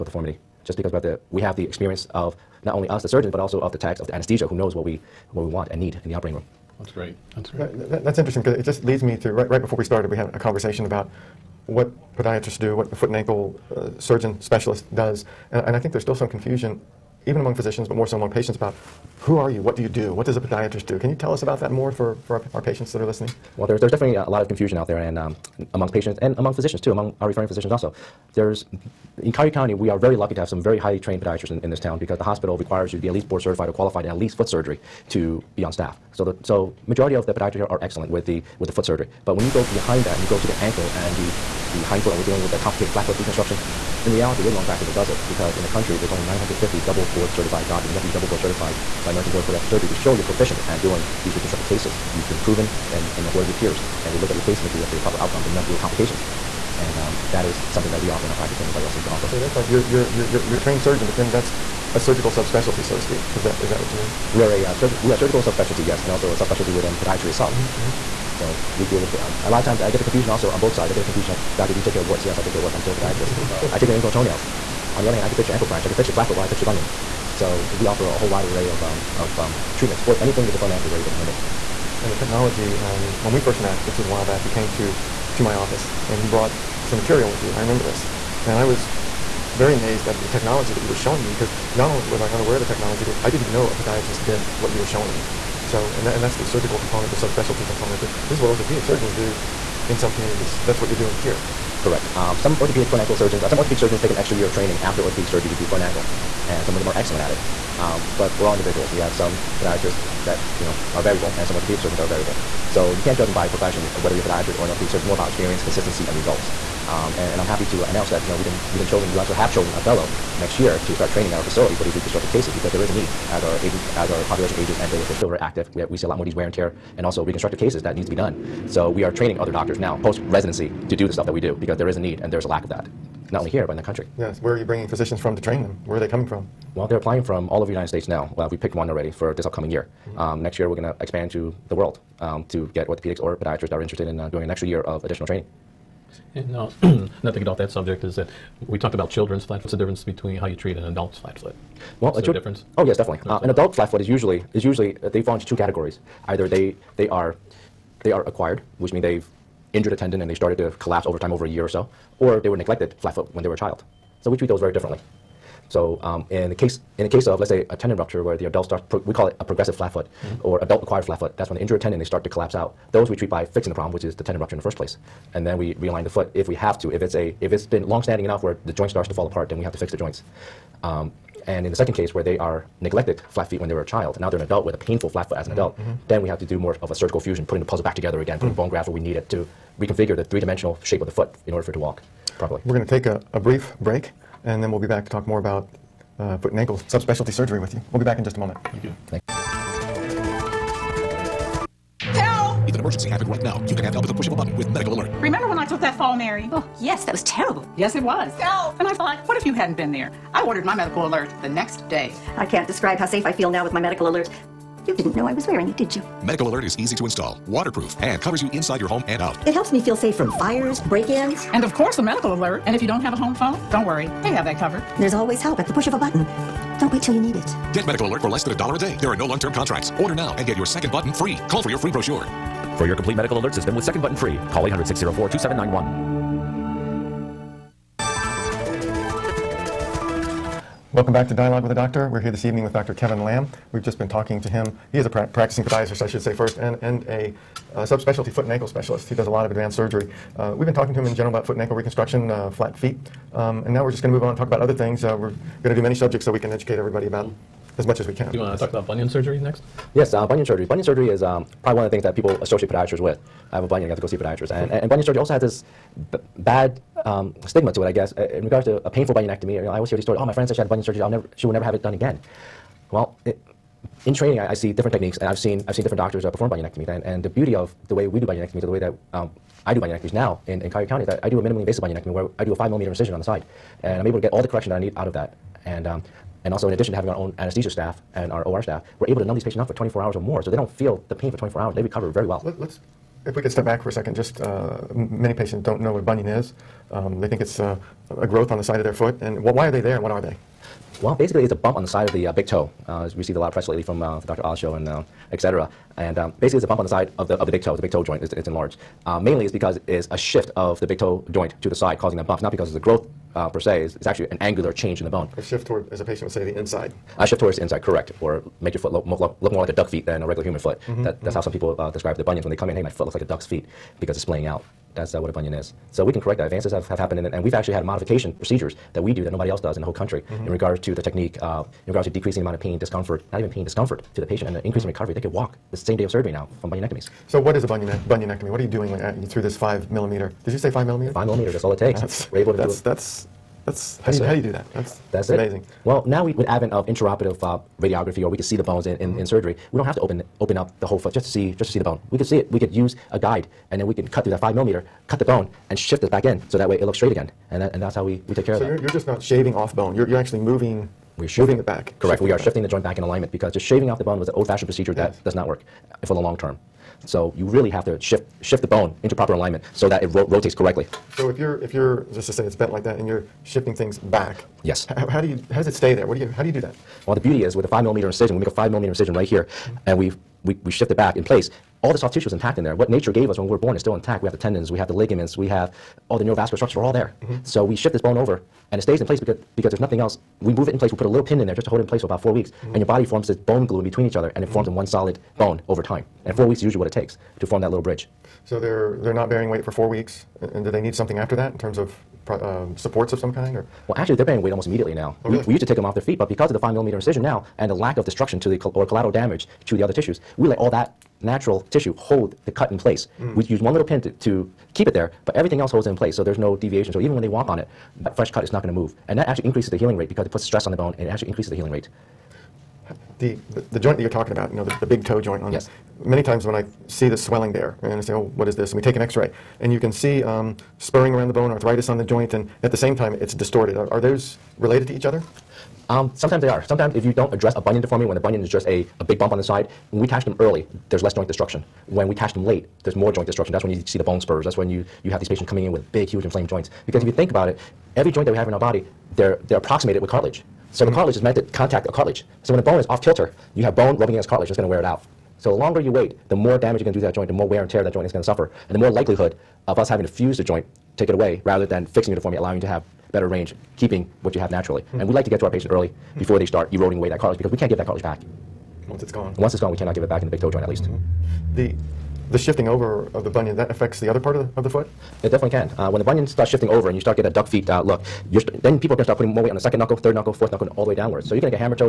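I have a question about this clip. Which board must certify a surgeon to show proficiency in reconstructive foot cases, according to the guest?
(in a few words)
American Board of Podiatric Surgery.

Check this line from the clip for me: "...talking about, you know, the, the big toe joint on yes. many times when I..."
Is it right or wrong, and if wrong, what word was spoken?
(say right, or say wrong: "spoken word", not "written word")
right.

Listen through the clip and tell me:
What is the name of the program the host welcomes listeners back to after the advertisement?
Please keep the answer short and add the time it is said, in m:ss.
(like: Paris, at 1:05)
Dialogue with a Doctor, at 4:01.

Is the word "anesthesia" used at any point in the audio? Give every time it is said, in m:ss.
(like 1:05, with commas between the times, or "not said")
0:04, 4:47.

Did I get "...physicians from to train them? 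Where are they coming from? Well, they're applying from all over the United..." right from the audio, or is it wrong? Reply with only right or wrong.
right.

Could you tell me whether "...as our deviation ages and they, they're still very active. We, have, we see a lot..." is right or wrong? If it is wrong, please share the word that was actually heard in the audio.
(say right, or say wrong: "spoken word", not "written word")
wrong: "population", not "deviation".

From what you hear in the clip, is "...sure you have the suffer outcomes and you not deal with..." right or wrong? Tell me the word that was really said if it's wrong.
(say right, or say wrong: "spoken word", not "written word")
wrong: "proper", not "suffer".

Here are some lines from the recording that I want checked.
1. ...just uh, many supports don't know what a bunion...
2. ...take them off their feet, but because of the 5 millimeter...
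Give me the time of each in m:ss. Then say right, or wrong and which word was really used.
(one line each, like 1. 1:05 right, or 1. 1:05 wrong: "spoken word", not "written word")
1. 4:54 wrong: "patients", not "supports"
2. 6:45 right.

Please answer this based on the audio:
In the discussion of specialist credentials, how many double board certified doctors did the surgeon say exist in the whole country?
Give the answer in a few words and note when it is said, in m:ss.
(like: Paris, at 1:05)
950, at 0:46.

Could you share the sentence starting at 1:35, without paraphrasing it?
So, and, that, and that's the surgical component, the subspecialty component.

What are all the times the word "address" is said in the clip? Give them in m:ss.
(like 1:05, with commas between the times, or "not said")
7:17.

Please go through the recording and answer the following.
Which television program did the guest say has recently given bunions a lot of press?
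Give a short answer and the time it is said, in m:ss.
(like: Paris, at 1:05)
the Dr. Oz show, at 5:04.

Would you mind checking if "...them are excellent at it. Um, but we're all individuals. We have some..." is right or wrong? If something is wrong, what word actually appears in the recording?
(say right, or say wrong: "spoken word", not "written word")
right.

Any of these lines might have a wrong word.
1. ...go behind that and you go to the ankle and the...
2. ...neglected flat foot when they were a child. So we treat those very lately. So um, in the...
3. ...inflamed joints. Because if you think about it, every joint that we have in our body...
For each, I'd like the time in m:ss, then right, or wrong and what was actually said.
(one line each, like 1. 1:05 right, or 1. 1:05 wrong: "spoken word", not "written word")
1. 0:39 right
2. 2:42 wrong: "differently", not "lately"
3. 7:26 right.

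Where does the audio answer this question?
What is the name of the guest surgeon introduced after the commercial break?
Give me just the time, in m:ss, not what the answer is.
4:02.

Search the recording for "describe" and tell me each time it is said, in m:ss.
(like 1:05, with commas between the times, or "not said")
3:32, 5:21.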